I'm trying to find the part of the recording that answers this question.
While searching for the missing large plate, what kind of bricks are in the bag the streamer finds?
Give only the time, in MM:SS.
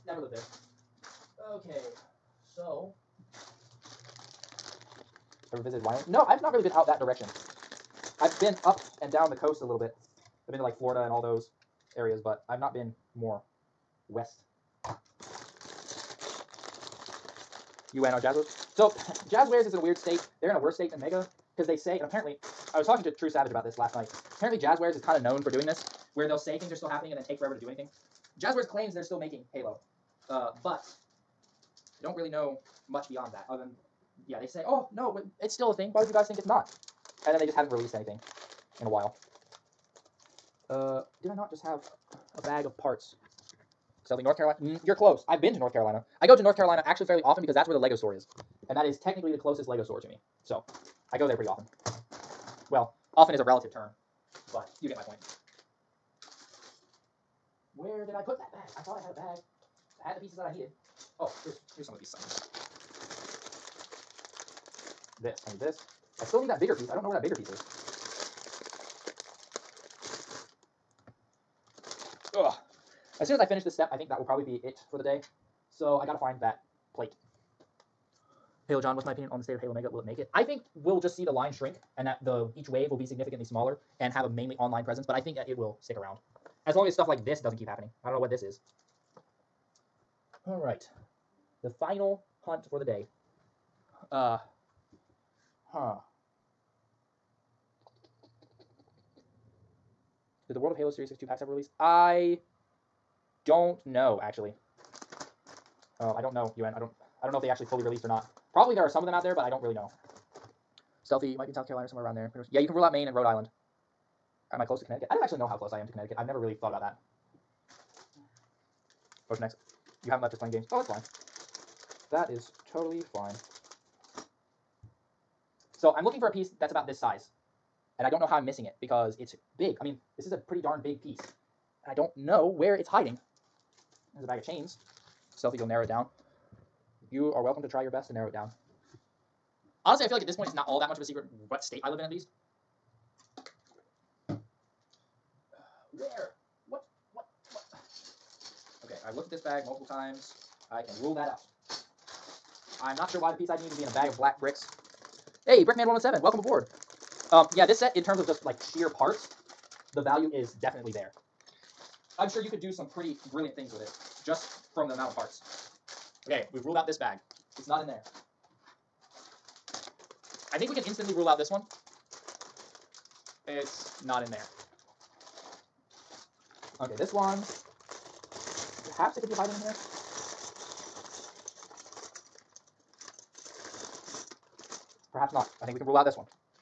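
02:34.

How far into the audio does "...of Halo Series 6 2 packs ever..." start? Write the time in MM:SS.
01:40.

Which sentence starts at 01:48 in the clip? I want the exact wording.
Probably there are some of them out there, but I don't really know.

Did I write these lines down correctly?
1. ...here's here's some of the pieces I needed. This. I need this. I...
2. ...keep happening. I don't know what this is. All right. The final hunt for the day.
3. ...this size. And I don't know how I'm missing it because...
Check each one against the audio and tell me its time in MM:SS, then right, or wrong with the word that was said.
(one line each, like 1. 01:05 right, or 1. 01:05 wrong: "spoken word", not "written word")
1. 01:01 right
2. 01:27 right
3. 02:06 right.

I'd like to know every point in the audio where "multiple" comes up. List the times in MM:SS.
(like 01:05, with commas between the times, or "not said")
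02:29.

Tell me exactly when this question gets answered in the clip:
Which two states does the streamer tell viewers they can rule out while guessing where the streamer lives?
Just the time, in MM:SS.
01:52.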